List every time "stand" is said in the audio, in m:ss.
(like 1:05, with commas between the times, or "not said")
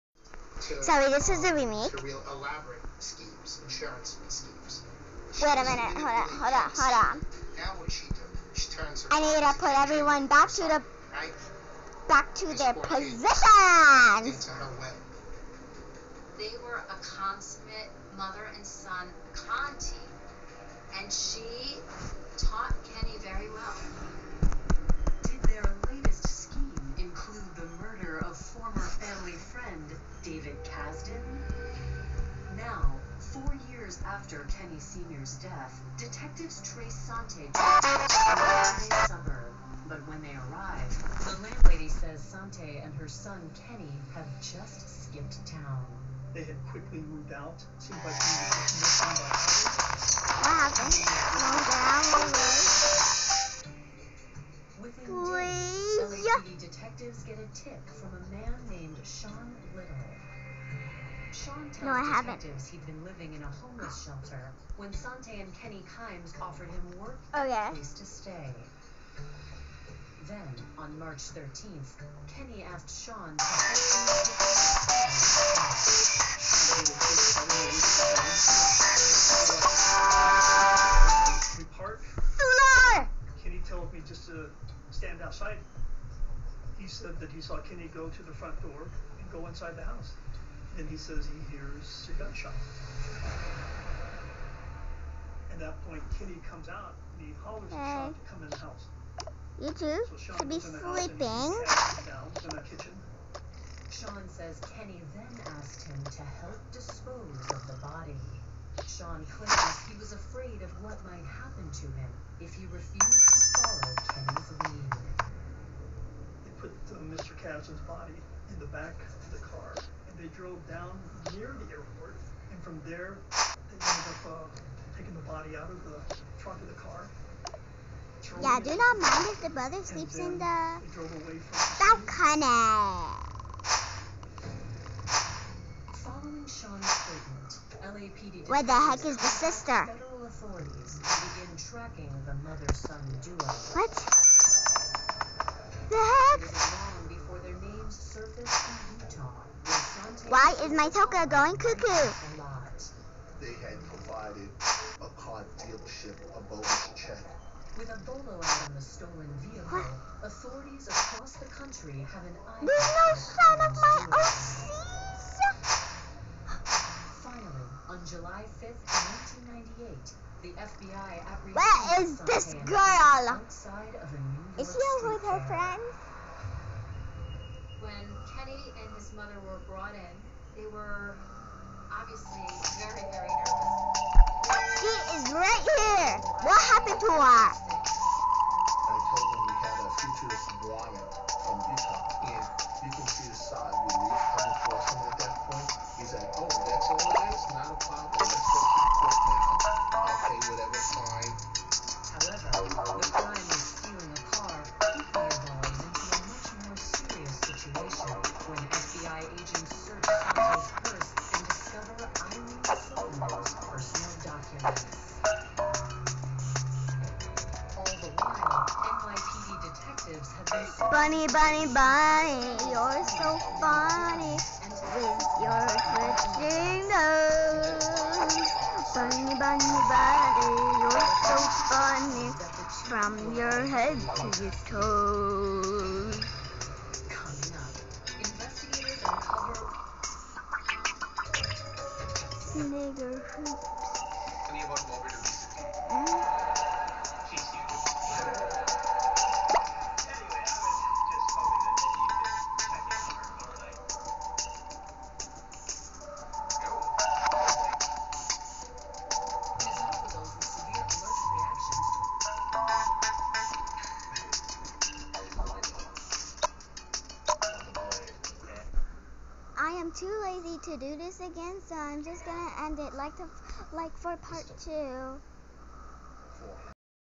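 1:24.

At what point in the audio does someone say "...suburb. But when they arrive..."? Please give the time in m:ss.
0:39.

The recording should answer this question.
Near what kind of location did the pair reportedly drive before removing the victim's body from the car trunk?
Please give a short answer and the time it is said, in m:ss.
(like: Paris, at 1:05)
The airport, at 2:01.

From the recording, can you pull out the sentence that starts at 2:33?
They had provided a car dealership a bonus check.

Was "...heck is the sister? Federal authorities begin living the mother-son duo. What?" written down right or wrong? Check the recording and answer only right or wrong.
wrong.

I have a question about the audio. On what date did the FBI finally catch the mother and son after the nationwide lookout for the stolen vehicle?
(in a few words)
July 5th, 1998.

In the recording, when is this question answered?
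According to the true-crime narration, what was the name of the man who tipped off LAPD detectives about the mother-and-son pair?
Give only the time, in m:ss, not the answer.
0:59.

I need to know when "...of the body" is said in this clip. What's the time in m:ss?
1:47.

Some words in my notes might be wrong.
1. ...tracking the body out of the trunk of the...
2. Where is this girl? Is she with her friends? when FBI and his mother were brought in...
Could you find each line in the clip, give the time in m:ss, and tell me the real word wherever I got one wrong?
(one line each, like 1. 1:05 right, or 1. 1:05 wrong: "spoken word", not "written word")
1. 2:04 wrong: "taking", not "tracking"
2. 2:51 wrong: "Kenny", not "FBI".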